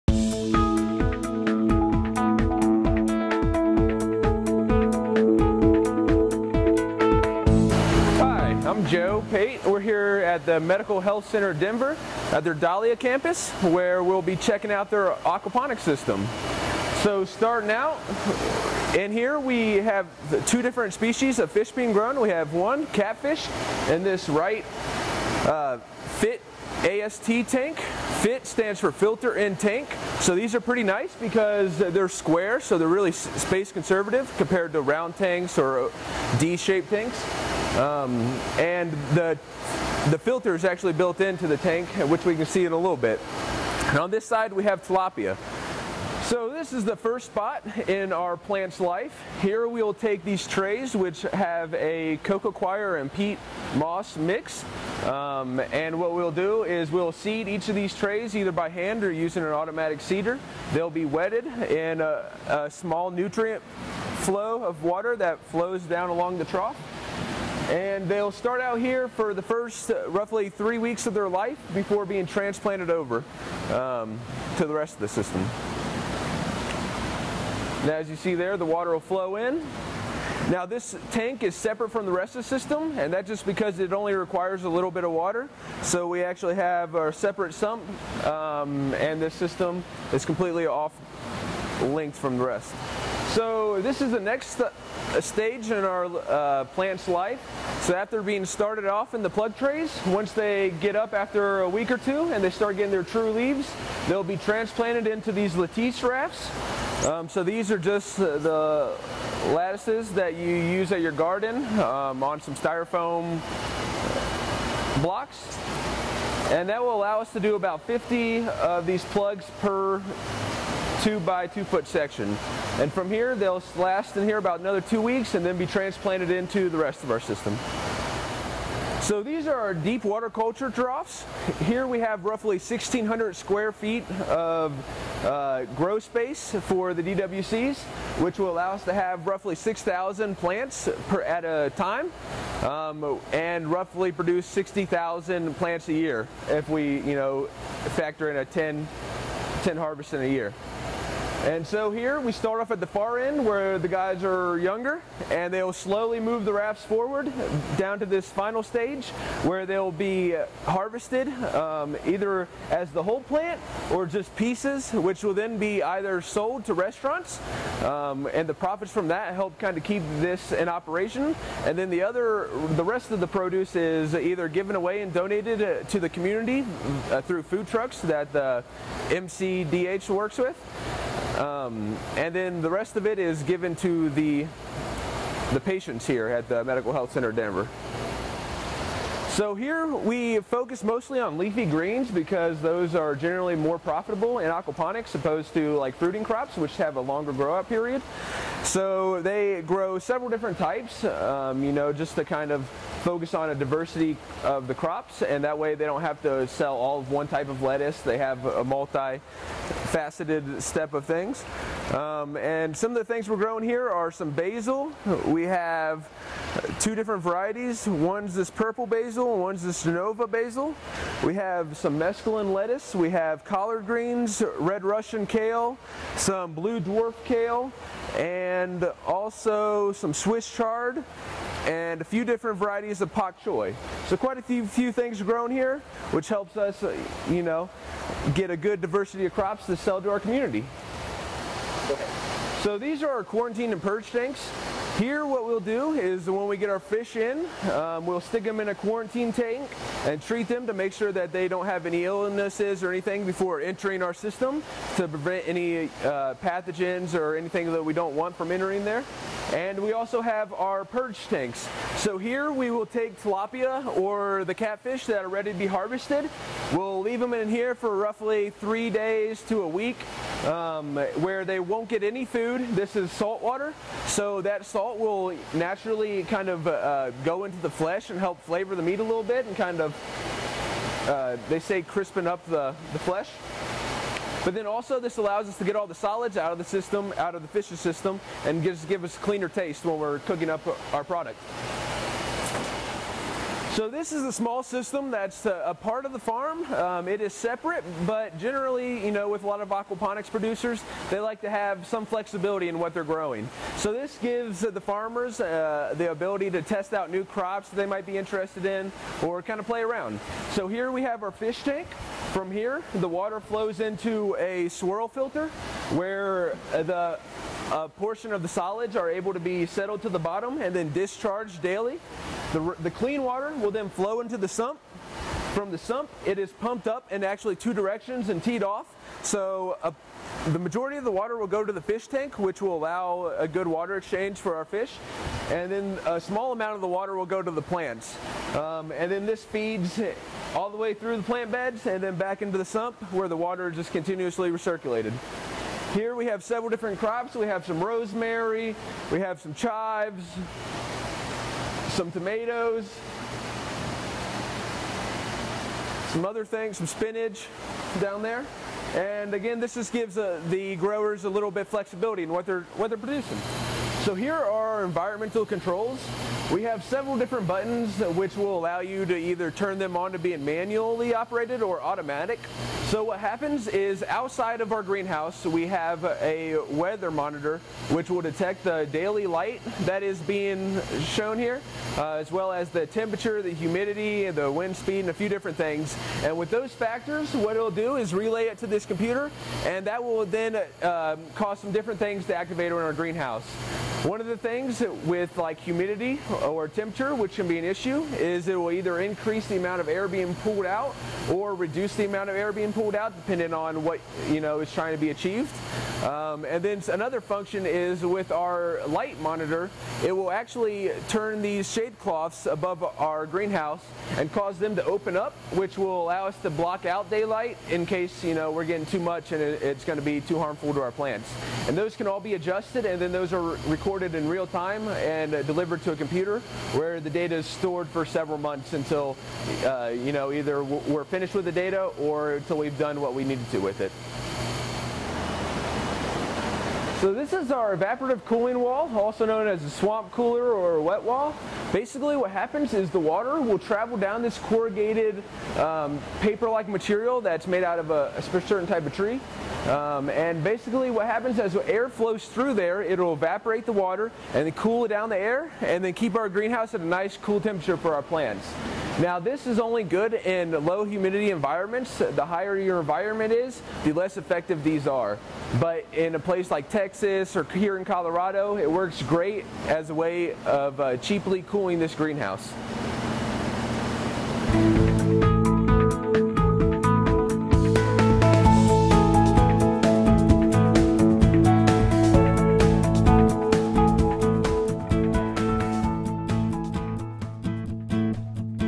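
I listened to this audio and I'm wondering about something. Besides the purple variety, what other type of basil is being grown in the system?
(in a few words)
Nova basil.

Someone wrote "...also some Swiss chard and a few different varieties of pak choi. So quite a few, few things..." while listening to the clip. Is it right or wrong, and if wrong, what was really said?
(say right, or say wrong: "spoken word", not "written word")
right.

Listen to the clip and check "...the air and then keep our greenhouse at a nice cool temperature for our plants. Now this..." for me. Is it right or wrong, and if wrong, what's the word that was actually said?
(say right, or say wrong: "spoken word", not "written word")
right.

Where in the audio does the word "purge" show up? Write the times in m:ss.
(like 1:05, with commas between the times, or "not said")
4:03, 4:20.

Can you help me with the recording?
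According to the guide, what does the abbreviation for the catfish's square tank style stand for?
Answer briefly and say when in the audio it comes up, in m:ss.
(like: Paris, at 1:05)
filter in tank, at 0:28.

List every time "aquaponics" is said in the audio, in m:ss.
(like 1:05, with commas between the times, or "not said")
0:15, 3:14, 4:59.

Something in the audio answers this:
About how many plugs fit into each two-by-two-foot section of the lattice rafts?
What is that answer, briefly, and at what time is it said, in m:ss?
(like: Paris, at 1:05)
50, at 1:57.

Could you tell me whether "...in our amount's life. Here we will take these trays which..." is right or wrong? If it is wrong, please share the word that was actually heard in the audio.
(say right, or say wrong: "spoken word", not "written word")
wrong: "plant", not "amount".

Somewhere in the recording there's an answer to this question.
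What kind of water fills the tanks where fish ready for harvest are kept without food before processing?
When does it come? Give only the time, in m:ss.
4:33.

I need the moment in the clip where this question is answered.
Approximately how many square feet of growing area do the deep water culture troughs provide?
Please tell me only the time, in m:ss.
2:12.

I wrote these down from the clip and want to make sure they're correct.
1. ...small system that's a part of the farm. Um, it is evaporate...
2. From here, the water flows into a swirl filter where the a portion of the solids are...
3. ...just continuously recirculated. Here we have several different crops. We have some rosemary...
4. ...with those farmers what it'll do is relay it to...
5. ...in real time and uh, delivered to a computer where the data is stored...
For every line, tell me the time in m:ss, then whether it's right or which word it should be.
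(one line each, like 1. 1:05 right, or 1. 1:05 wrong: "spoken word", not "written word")
1. 4:54 wrong: "separate", not "evaporate"
2. 5:12 right
3. 5:43 right
4. 6:26 wrong: "factors", not "farmers"
5. 7:04 right.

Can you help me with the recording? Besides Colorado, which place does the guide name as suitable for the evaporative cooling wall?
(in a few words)
Texas.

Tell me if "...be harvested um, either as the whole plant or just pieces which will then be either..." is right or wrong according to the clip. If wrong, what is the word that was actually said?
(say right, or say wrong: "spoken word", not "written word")
right.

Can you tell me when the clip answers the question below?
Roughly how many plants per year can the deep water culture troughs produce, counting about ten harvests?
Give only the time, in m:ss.
2:24.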